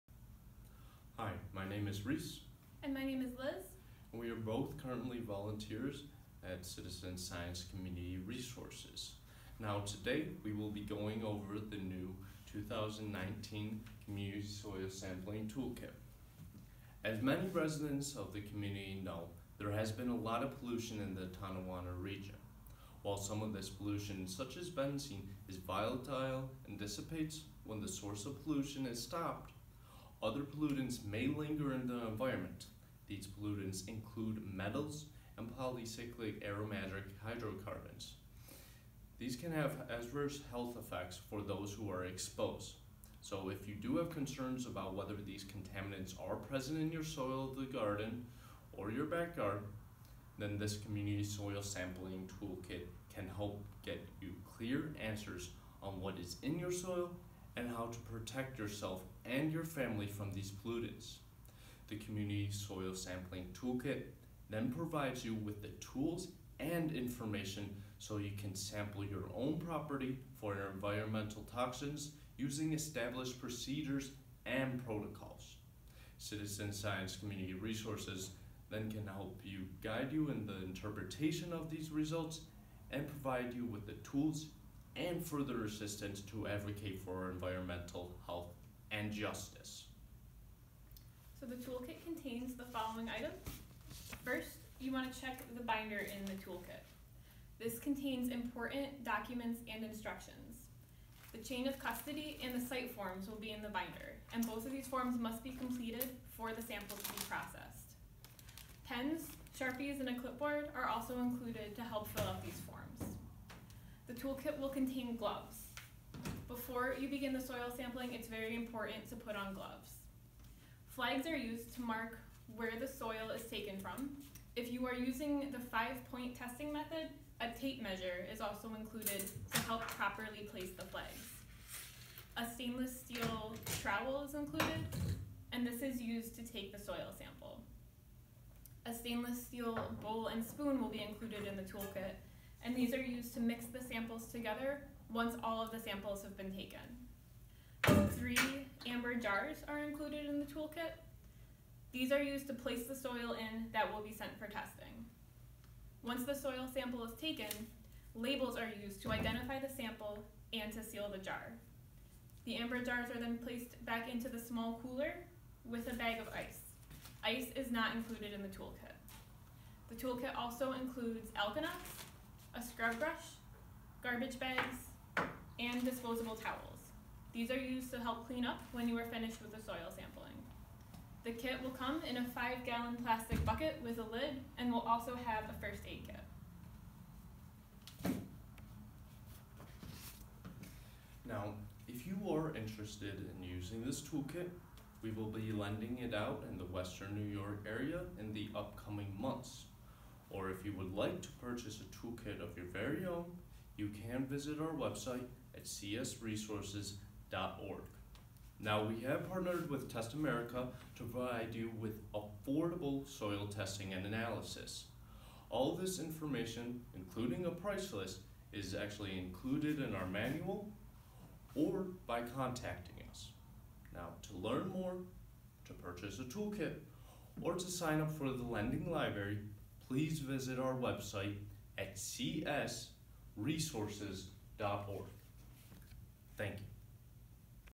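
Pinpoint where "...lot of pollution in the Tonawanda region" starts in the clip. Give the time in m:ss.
0:20.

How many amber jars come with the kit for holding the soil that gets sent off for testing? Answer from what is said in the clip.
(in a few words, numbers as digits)
3.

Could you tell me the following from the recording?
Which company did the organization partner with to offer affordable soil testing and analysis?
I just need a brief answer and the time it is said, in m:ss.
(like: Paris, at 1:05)
Test America, at 3:29.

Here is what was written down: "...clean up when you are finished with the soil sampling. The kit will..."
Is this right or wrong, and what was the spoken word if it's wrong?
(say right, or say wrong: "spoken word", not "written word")
right.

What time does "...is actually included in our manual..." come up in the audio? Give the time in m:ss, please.
3:38.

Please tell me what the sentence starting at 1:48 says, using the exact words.
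Pens, Sharpies, and a clipboard are also included to help fill toolkit will contain gloves.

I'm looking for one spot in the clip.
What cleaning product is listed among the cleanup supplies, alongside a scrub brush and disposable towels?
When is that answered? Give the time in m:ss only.
2:51.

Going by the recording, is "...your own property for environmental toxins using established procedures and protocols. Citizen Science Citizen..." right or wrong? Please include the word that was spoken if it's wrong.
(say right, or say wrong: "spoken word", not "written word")
wrong: "Community", not "Citizen".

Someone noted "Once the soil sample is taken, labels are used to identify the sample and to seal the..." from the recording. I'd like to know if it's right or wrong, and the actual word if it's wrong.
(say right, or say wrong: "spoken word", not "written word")
right.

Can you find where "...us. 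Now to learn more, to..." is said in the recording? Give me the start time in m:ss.
3:43.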